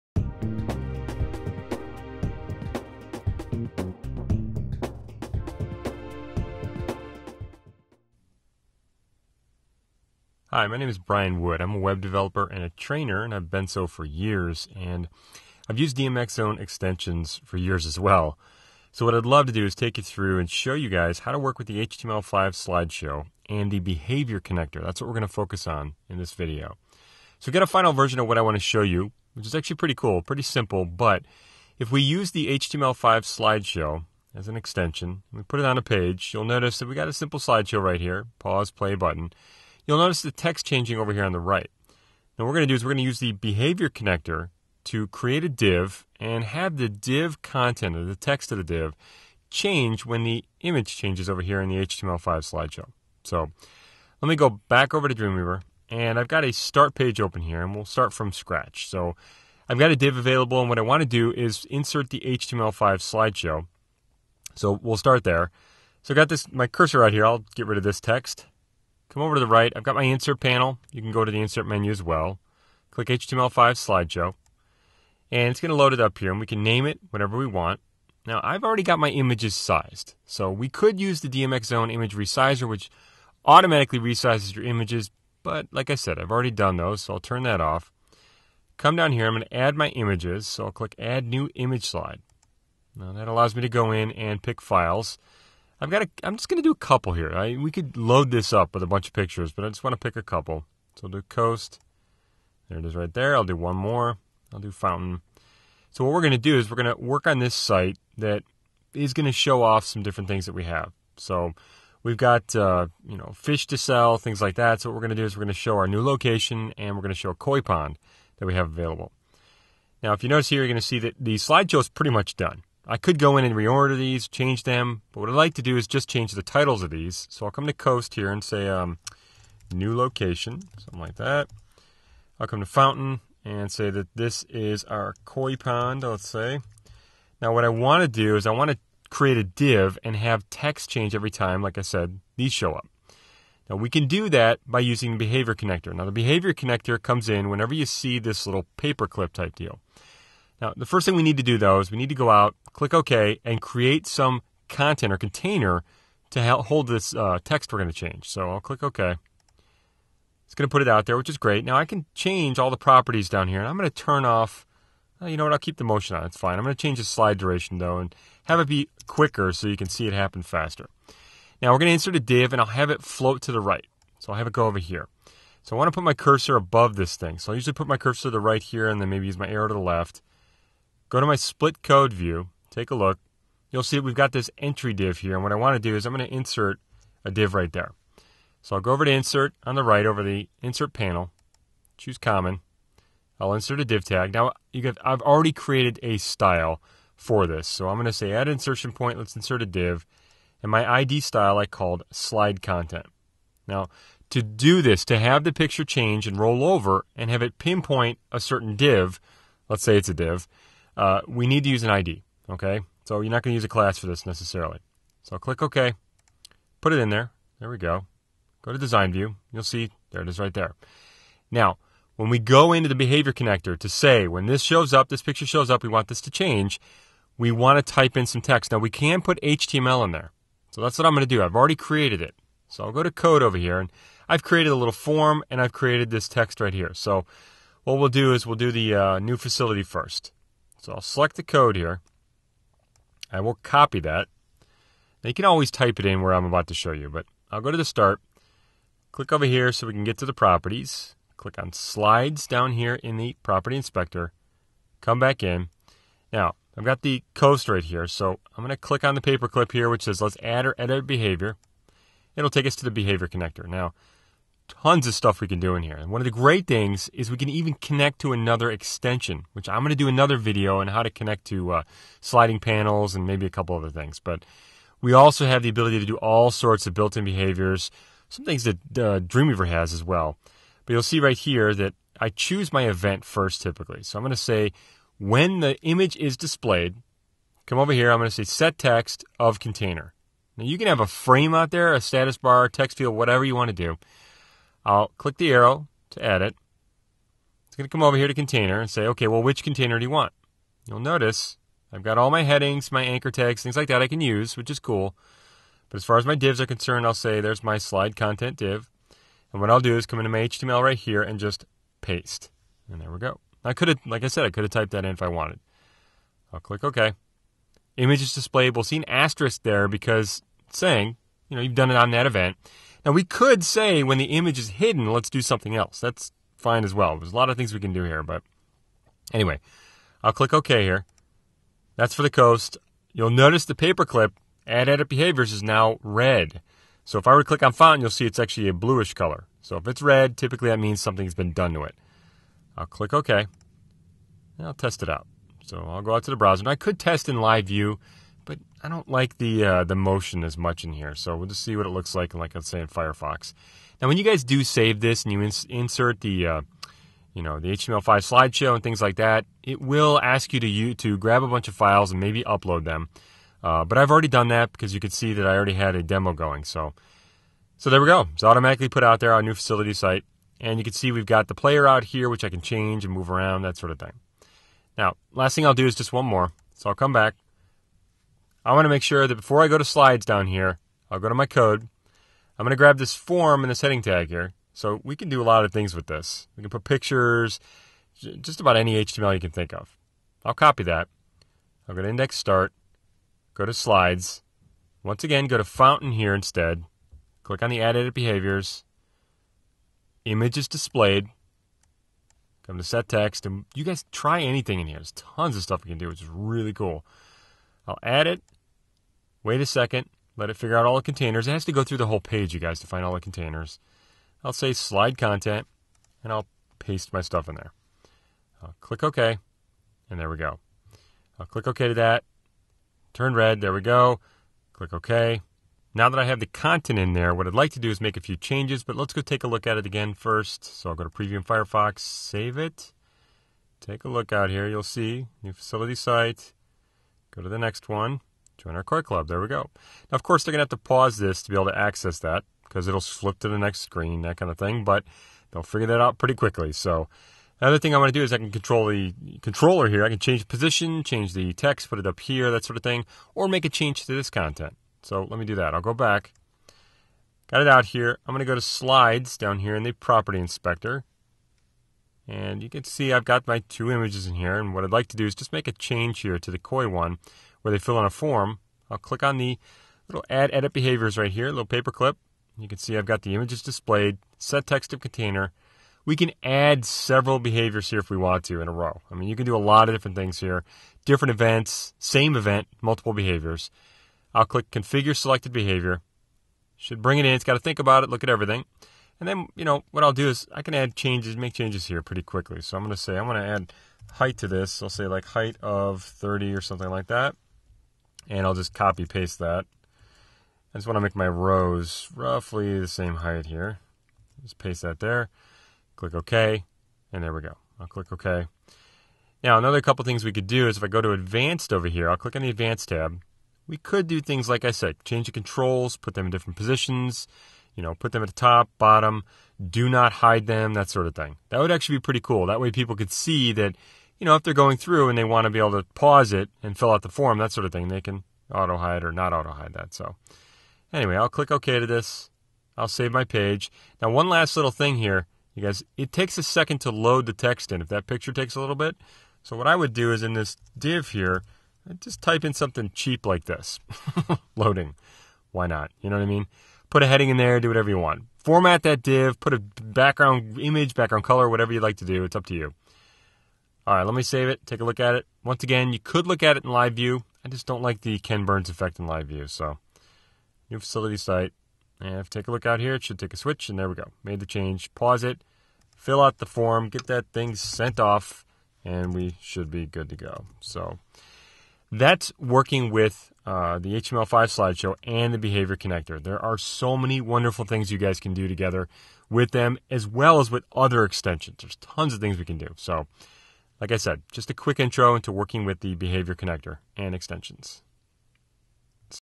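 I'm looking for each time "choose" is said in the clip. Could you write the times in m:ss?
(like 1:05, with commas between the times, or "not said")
3:11, 4:42.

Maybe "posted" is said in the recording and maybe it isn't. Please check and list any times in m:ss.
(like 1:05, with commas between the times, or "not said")
not said.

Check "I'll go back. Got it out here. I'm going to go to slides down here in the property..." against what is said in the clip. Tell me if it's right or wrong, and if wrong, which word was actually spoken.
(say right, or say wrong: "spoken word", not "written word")
right.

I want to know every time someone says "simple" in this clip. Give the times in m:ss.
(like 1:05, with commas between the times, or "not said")
0:30, 0:37.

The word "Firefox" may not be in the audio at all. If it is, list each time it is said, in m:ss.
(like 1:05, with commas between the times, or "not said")
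5:52, 7:11.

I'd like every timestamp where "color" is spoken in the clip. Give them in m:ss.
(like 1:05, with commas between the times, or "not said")
5:39, 9:11.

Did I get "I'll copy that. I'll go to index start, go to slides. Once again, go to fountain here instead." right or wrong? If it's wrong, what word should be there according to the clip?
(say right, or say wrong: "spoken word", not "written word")
right.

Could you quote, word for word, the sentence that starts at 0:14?
And I've used DMXzone extensions for years as well.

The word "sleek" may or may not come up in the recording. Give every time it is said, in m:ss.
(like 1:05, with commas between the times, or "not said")
not said.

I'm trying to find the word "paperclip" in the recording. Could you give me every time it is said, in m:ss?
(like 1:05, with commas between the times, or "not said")
2:28, 4:19, 5:33, 7:51.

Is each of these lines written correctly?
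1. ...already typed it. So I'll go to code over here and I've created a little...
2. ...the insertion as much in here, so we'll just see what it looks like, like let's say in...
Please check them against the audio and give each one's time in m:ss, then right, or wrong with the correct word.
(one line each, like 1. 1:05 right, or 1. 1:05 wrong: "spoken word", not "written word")
1. 3:51 wrong: "created", not "typed"
2. 5:49 wrong: "motion", not "insertion".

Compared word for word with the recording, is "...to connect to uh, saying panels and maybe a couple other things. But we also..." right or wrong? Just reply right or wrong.
wrong.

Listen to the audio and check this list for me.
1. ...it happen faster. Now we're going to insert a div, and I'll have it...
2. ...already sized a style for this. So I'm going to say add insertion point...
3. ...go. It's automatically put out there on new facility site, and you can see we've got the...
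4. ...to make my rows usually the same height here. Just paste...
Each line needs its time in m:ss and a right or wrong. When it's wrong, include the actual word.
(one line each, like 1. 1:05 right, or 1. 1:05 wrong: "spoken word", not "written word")
1. 2:50 right
2. 3:15 wrong: "created", not "sized"
3. 6:08 right
4. 8:20 wrong: "roughly", not "usually".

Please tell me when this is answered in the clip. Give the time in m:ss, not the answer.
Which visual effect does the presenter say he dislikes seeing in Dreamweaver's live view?
9:18.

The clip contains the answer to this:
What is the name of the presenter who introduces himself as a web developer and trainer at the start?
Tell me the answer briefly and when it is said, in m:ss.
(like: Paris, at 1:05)
Brian Wood, at 0:10.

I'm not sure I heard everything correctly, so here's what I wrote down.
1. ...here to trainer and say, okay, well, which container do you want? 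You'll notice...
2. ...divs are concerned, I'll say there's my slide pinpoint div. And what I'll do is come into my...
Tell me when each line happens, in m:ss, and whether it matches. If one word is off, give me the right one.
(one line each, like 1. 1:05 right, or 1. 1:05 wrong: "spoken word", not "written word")
1. 4:58 wrong: "container", not "trainer"
2. 5:06 wrong: "content", not "pinpoint".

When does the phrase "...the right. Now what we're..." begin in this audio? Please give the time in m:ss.
0:41.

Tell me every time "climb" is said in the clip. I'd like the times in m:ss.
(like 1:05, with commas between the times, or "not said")
not said.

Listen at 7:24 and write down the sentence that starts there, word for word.
But they'll figure that out pretty quickly.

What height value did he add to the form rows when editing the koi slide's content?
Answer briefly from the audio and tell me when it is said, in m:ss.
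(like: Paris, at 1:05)
30, at 8:16.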